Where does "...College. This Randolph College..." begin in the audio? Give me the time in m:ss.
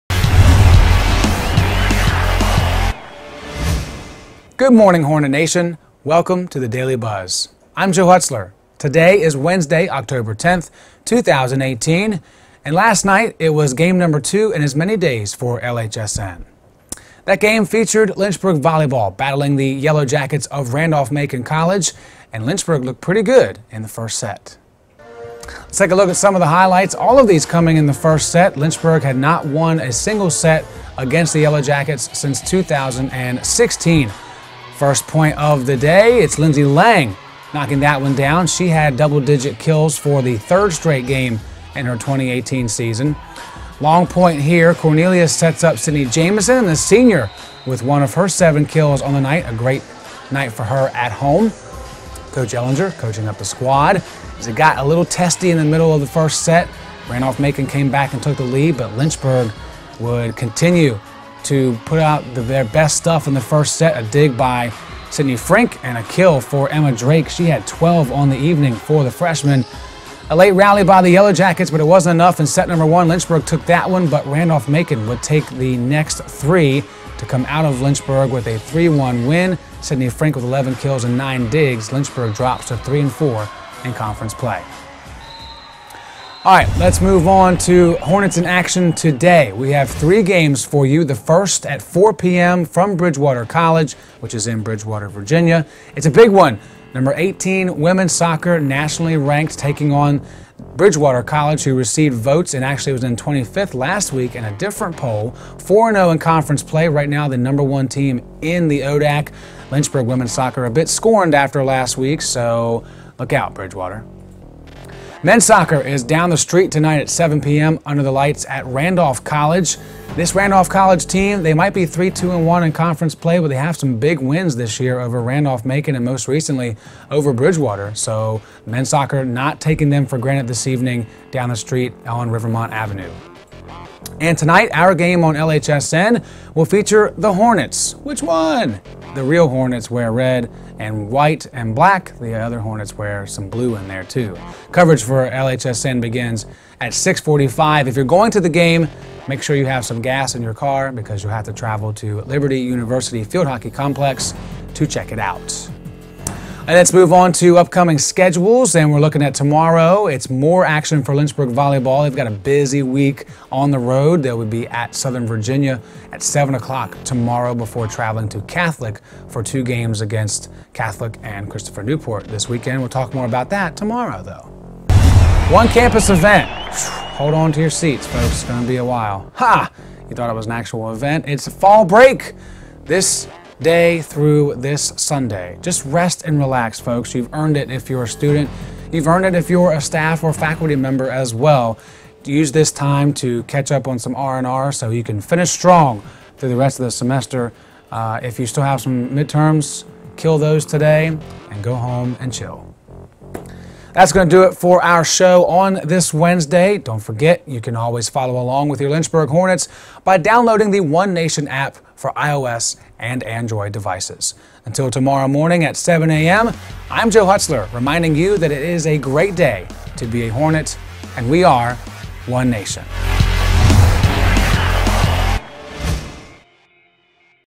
1:59.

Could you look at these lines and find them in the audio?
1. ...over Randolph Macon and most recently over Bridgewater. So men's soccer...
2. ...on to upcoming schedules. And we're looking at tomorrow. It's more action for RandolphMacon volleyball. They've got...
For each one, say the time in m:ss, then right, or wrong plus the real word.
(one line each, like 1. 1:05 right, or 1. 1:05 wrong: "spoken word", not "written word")
1. 2:04 right
2. 2:37 wrong: "Lynchburg", not "RandolphMacon".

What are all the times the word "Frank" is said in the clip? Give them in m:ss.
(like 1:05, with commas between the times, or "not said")
1:05, 1:20.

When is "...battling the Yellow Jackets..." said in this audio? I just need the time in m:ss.
0:19.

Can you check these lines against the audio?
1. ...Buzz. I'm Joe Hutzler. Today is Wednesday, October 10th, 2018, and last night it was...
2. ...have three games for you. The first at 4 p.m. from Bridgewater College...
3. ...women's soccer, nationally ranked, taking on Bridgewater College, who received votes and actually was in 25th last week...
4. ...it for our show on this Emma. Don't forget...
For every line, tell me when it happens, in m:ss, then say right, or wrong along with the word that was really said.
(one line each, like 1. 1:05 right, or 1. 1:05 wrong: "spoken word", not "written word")
1. 0:06 right
2. 1:29 right
3. 1:37 right
4. 3:24 wrong: "Wednesday", not "Emma".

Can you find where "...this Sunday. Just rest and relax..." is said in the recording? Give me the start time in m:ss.
3:04.